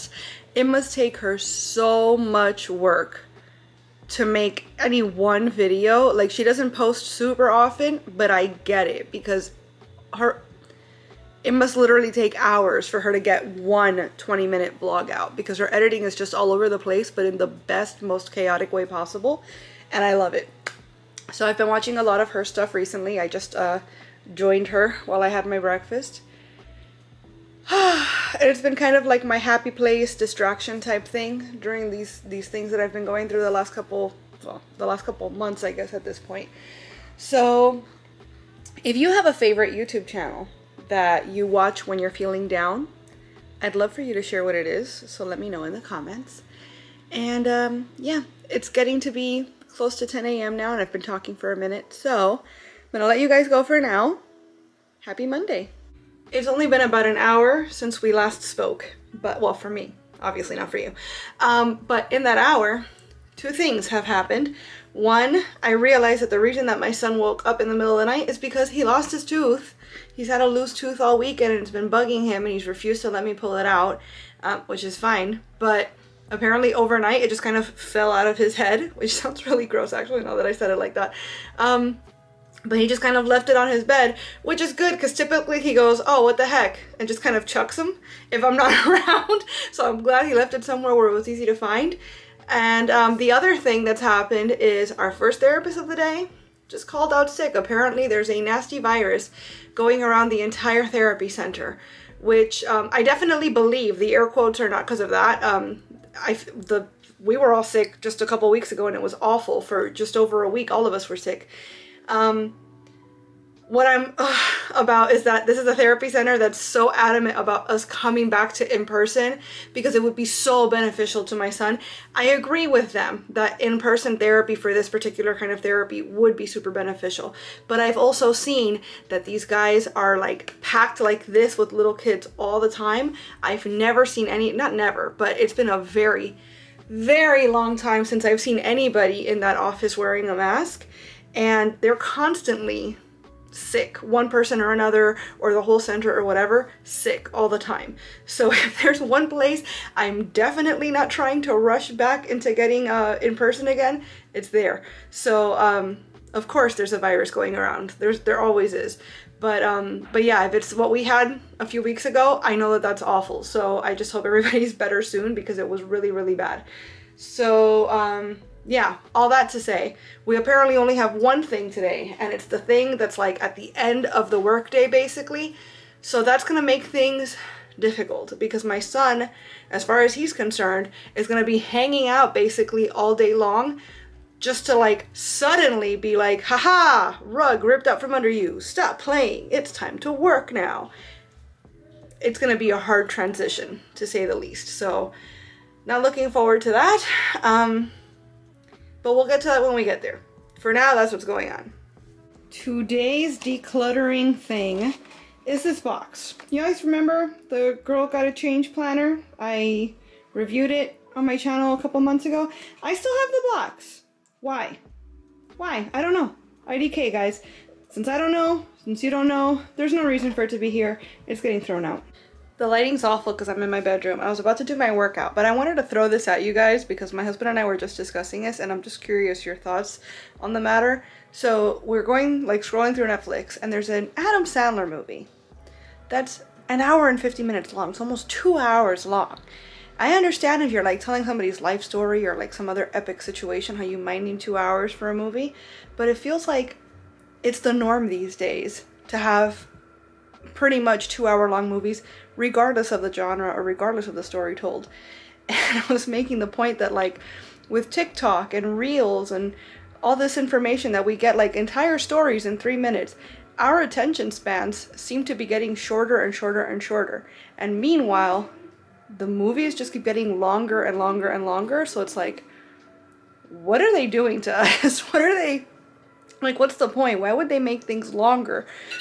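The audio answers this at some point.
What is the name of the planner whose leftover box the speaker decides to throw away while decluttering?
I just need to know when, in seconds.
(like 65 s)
207 s.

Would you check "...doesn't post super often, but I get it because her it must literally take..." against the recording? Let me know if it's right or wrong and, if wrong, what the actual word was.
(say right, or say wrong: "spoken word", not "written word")
right.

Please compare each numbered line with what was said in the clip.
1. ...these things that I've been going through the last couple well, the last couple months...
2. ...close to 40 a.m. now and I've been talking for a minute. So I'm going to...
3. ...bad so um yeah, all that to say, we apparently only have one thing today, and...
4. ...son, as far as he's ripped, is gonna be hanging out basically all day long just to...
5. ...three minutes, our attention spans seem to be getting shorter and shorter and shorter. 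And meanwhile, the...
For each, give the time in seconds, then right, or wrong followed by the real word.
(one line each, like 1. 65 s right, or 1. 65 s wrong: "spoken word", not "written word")
1. 32 s right
2. 49 s wrong: "10", not "40"
3. 166 s right
4. 178 s wrong: "concerned", not "ripped"
5. 262 s right.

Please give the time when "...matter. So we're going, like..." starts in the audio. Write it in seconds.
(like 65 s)
230 s.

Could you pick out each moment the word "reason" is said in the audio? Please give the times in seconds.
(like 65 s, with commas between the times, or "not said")
66 s, 220 s.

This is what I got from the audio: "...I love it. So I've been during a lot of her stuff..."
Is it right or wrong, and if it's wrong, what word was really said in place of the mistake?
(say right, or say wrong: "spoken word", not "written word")
wrong: "watching", not "during".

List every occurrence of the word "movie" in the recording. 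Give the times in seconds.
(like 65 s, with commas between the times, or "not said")
234 s, 245 s, 251 s, 269 s.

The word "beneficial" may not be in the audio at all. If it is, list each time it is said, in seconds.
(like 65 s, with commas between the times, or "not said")
120 s, 126 s.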